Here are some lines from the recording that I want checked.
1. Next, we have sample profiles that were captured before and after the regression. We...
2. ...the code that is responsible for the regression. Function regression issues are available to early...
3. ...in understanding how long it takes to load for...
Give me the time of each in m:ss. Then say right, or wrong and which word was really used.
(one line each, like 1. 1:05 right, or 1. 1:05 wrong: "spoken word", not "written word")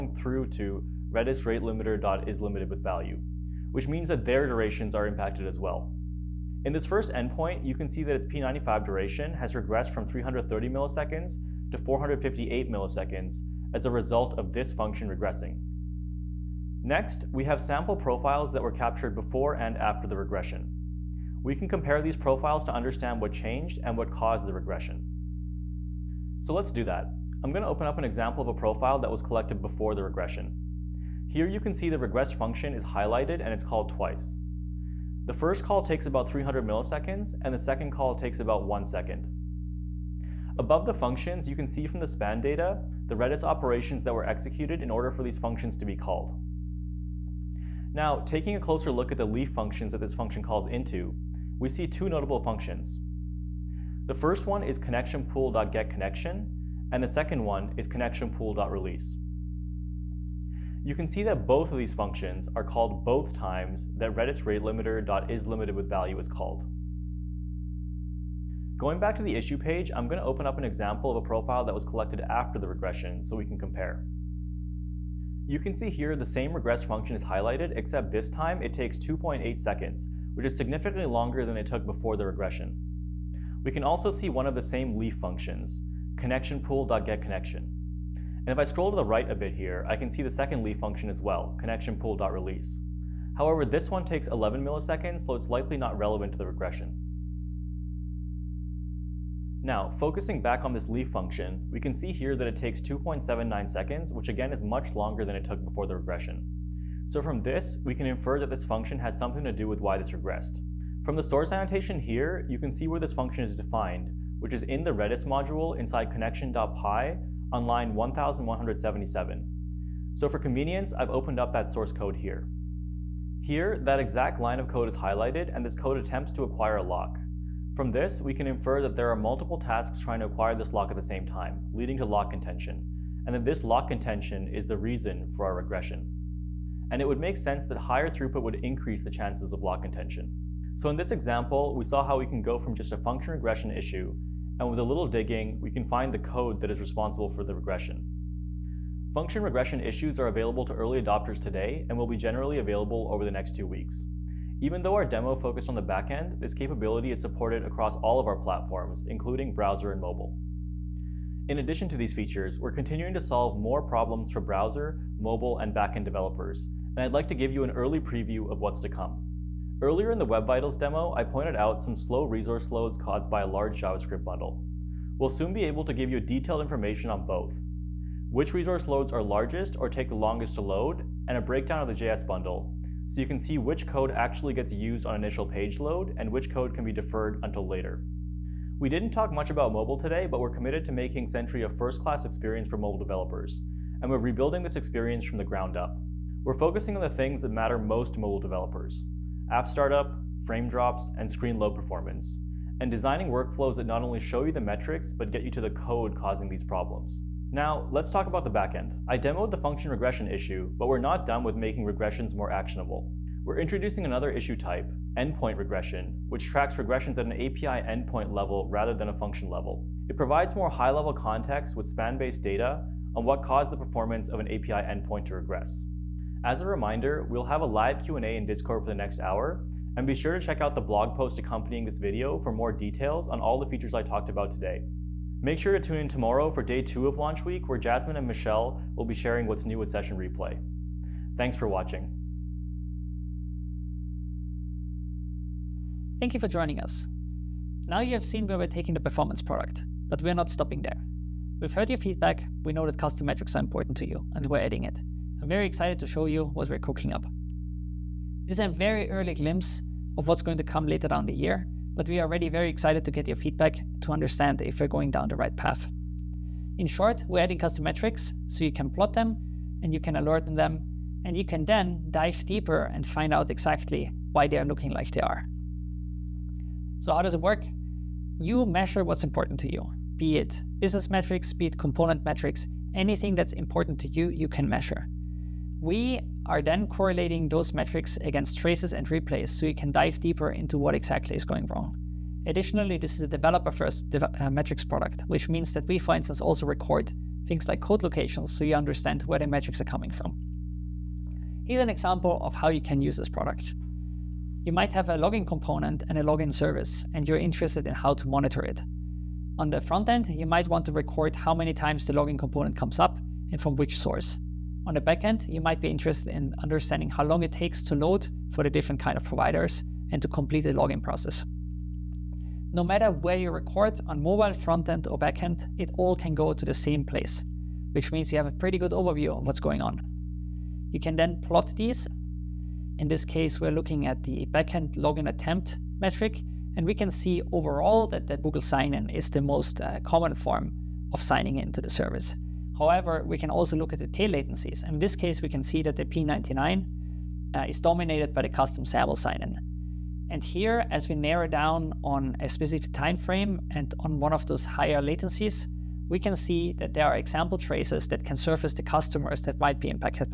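1. 0:16 right
2. 2:26 right
3. 5:16 right.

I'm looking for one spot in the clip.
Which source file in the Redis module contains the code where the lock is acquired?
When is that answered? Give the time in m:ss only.
1:56.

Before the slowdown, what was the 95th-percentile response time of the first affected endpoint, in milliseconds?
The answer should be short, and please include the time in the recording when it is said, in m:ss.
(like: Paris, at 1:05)
330 milliseconds, at 0:10.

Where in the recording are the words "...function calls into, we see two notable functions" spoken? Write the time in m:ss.
0:50.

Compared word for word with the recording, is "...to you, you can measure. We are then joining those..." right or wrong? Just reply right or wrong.
wrong.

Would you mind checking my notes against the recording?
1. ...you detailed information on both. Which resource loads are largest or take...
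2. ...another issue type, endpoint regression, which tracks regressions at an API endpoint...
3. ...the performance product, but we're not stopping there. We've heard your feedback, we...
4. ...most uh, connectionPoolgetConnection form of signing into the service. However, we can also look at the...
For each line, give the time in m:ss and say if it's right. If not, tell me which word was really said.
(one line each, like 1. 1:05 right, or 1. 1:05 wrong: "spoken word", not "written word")
1. 2:56 right
2. 3:34 right
3. 4:08 right
4. 5:39 wrong: "common", not "connectionPoolgetConnection".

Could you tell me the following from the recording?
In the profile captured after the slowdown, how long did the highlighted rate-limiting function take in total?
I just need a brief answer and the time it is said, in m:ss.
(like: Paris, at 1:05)
2.8 seconds, at 1:18.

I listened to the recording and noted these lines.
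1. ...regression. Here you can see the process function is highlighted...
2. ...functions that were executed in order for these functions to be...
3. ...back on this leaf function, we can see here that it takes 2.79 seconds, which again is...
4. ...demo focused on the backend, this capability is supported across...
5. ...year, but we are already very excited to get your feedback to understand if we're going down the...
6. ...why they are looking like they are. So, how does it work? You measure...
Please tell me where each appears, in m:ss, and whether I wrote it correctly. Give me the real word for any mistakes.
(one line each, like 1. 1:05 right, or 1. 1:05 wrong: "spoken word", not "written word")
1. 0:30 wrong: "regress", not "process"
2. 0:43 wrong: "operations", not "functions"
3. 1:40 right
4. 2:35 right
5. 4:21 right
6. 4:34 right.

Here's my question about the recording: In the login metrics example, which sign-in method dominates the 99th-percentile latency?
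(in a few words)
custom SAML sign-in.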